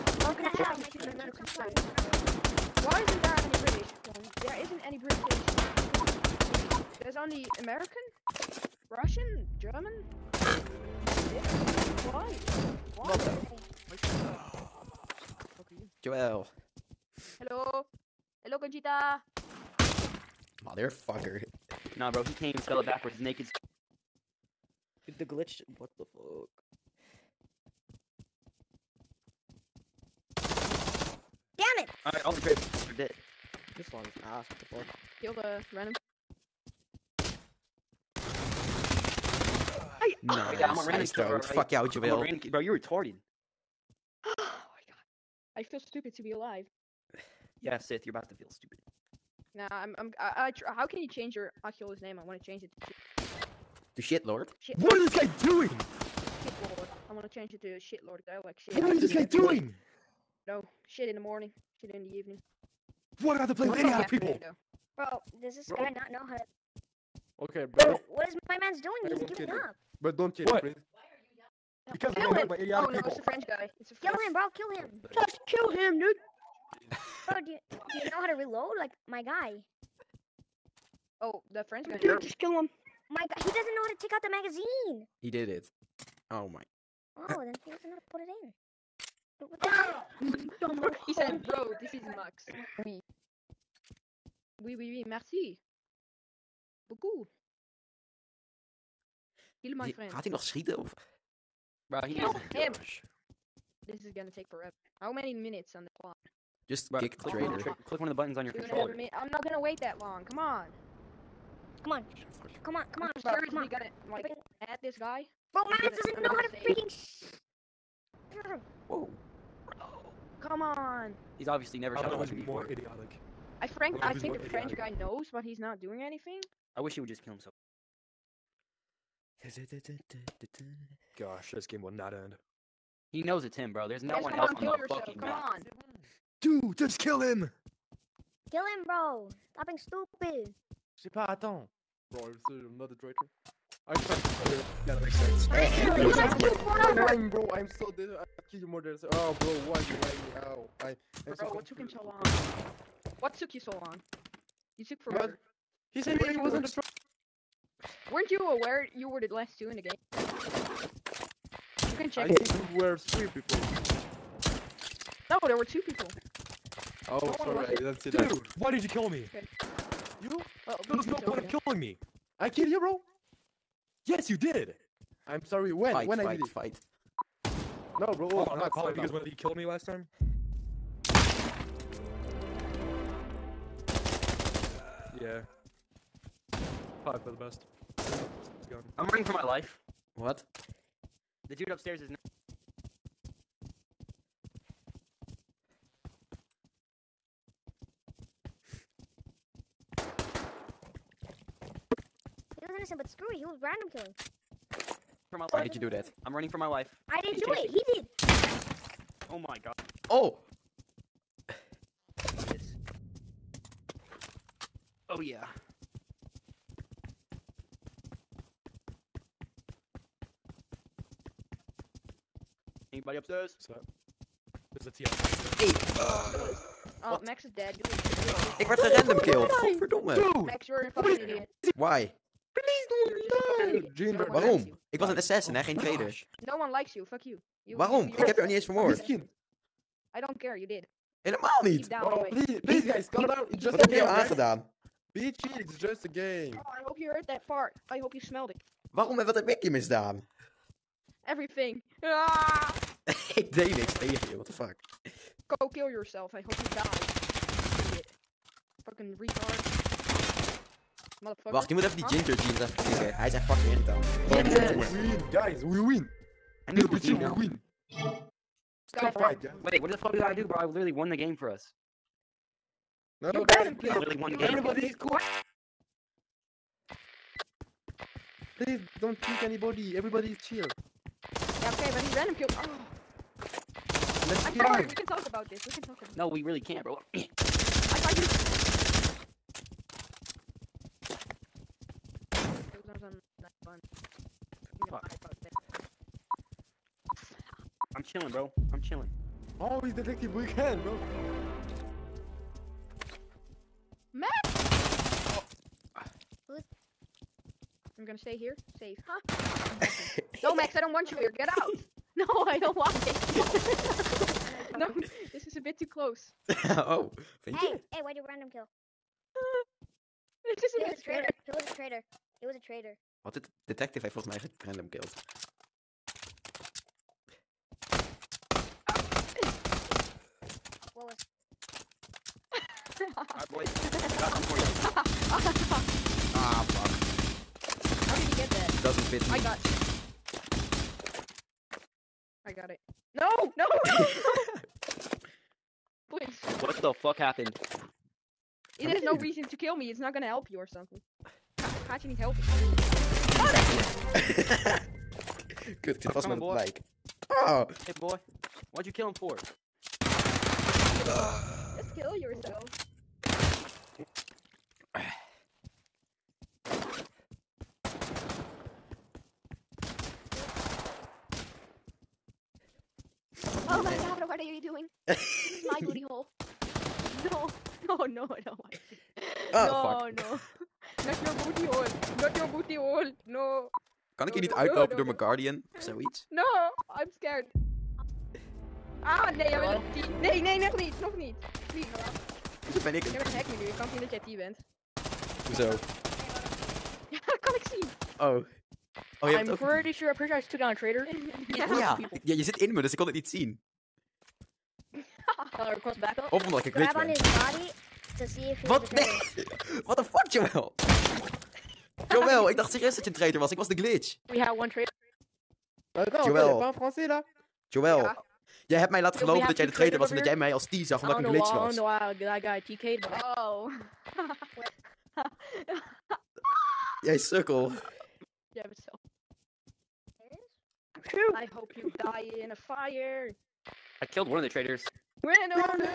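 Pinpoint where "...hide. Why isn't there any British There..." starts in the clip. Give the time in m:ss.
0:01.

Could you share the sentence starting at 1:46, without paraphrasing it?
Just click, click, one the click, one of the buttons on your controller.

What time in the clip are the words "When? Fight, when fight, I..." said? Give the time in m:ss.
2:55.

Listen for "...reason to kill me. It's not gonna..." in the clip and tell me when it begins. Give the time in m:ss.
5:49.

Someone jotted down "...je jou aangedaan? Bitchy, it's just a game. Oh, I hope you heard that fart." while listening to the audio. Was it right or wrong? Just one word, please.
right.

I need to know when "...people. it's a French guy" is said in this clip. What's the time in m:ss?
1:12.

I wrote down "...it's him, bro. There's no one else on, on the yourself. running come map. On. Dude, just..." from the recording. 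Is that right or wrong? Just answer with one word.
wrong.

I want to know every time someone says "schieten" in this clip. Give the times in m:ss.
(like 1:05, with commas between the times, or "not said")
1:40.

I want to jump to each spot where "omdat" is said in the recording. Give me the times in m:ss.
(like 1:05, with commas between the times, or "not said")
6:46, 7:01.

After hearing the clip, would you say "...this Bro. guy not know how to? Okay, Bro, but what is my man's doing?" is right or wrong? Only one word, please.
right.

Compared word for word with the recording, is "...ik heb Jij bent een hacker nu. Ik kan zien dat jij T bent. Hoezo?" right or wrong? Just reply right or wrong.
right.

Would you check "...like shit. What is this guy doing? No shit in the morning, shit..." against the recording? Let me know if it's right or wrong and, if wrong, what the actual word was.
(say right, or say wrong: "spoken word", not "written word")
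right.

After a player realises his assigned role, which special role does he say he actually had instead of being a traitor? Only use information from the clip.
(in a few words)
Assassin.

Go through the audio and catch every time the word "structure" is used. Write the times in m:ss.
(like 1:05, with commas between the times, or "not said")
not said.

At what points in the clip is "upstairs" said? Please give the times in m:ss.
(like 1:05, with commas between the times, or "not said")
3:11, 3:43.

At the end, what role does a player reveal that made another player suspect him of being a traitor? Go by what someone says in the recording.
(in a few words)
The glitch.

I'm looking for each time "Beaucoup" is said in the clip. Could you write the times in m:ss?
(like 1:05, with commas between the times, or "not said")
1:36.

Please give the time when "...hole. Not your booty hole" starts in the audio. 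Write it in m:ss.
6:21.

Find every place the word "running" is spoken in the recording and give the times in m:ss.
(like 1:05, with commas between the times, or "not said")
3:09, 3:26.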